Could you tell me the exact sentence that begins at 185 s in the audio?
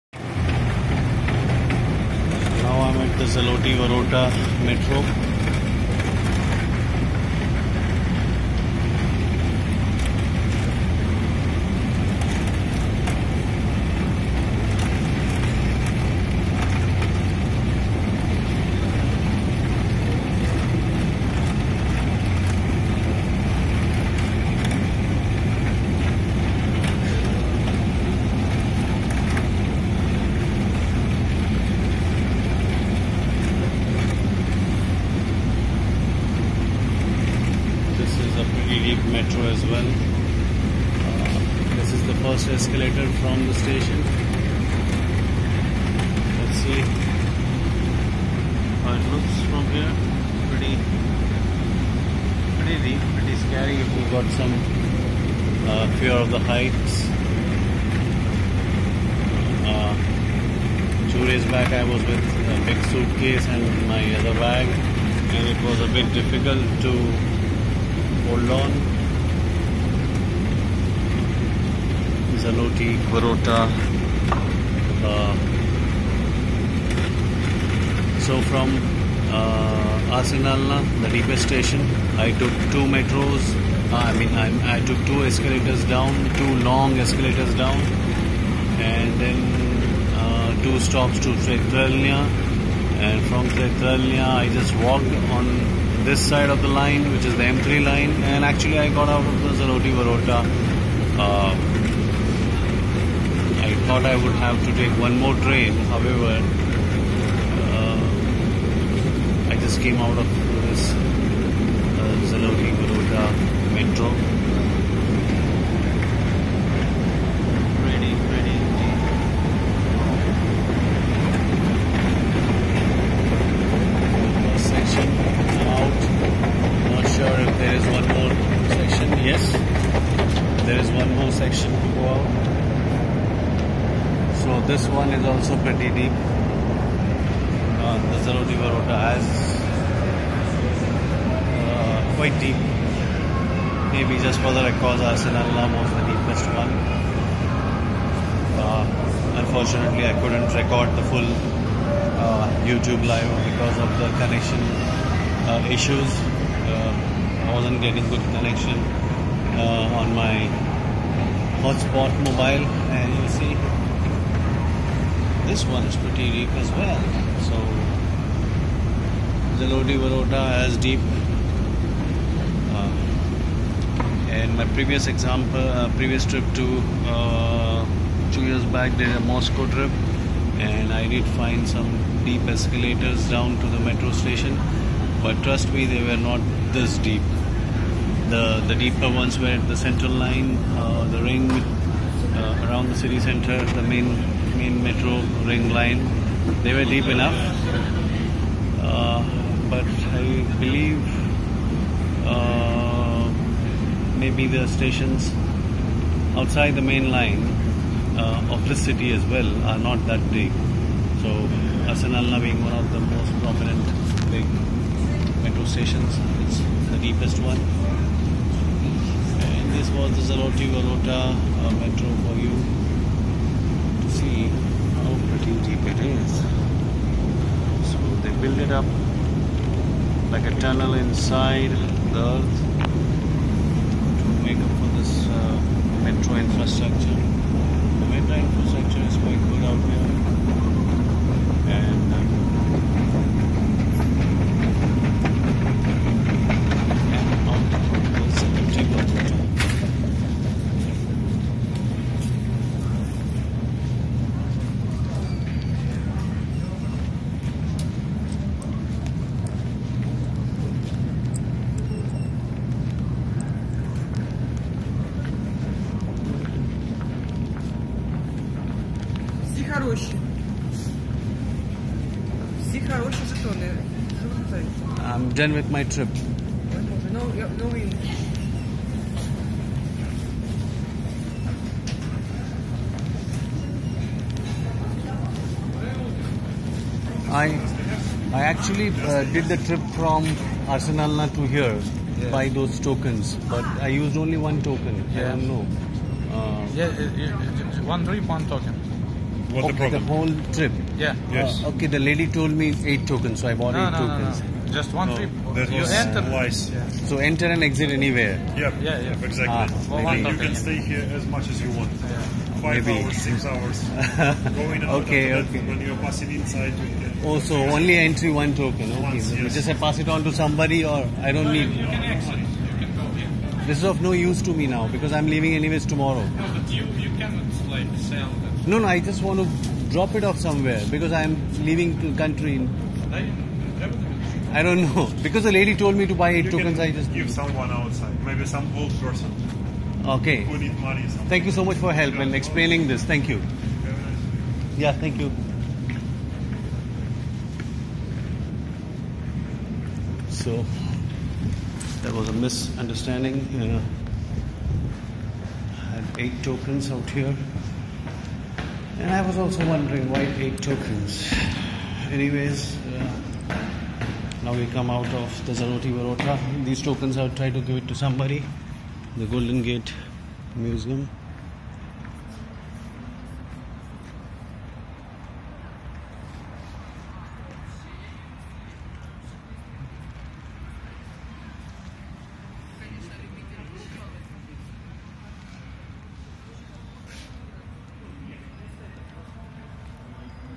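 But trust me, they were not this deep.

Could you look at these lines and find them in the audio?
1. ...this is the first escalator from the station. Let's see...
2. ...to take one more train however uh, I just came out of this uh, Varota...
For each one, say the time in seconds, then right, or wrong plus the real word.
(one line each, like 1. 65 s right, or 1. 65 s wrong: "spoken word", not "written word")
1. 41 s right
2. 104 s right.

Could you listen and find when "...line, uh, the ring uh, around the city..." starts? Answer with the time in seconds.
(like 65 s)
190 s.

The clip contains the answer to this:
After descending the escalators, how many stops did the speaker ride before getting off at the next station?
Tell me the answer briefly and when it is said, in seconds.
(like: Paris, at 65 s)
2, at 90 s.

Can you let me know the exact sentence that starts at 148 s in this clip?
Uh, unfortunately, I couldn't record the full uh, YouTube live because of the connection uh, issues.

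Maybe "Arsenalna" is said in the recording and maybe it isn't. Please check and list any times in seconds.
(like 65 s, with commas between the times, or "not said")
145 s, 211 s, 290 s.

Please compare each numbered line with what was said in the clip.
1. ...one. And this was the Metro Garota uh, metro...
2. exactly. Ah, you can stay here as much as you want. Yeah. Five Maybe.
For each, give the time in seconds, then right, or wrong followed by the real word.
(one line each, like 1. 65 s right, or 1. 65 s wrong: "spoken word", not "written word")
1. 217 s wrong: "Zaroti", not "Metro"
2. 309 s right.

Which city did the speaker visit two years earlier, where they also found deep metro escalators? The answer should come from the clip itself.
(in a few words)
Moscow.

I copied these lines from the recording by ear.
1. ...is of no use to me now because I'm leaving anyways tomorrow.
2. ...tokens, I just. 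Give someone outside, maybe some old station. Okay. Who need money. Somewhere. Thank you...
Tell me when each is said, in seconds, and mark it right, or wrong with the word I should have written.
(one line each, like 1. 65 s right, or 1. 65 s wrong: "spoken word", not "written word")
1. 323 s right
2. 336 s wrong: "person", not "station".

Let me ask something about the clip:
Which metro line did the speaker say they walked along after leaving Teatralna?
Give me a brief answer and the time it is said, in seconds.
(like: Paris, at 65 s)
M3, at 97 s.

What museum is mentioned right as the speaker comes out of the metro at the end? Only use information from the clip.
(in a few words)
Golden Gate Museum.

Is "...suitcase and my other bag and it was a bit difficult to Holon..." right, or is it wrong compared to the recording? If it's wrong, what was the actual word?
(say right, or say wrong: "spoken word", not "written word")
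right.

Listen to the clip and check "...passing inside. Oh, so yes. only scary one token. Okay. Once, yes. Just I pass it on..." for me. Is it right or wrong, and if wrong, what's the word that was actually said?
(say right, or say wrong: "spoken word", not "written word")
wrong: "entry", not "scary".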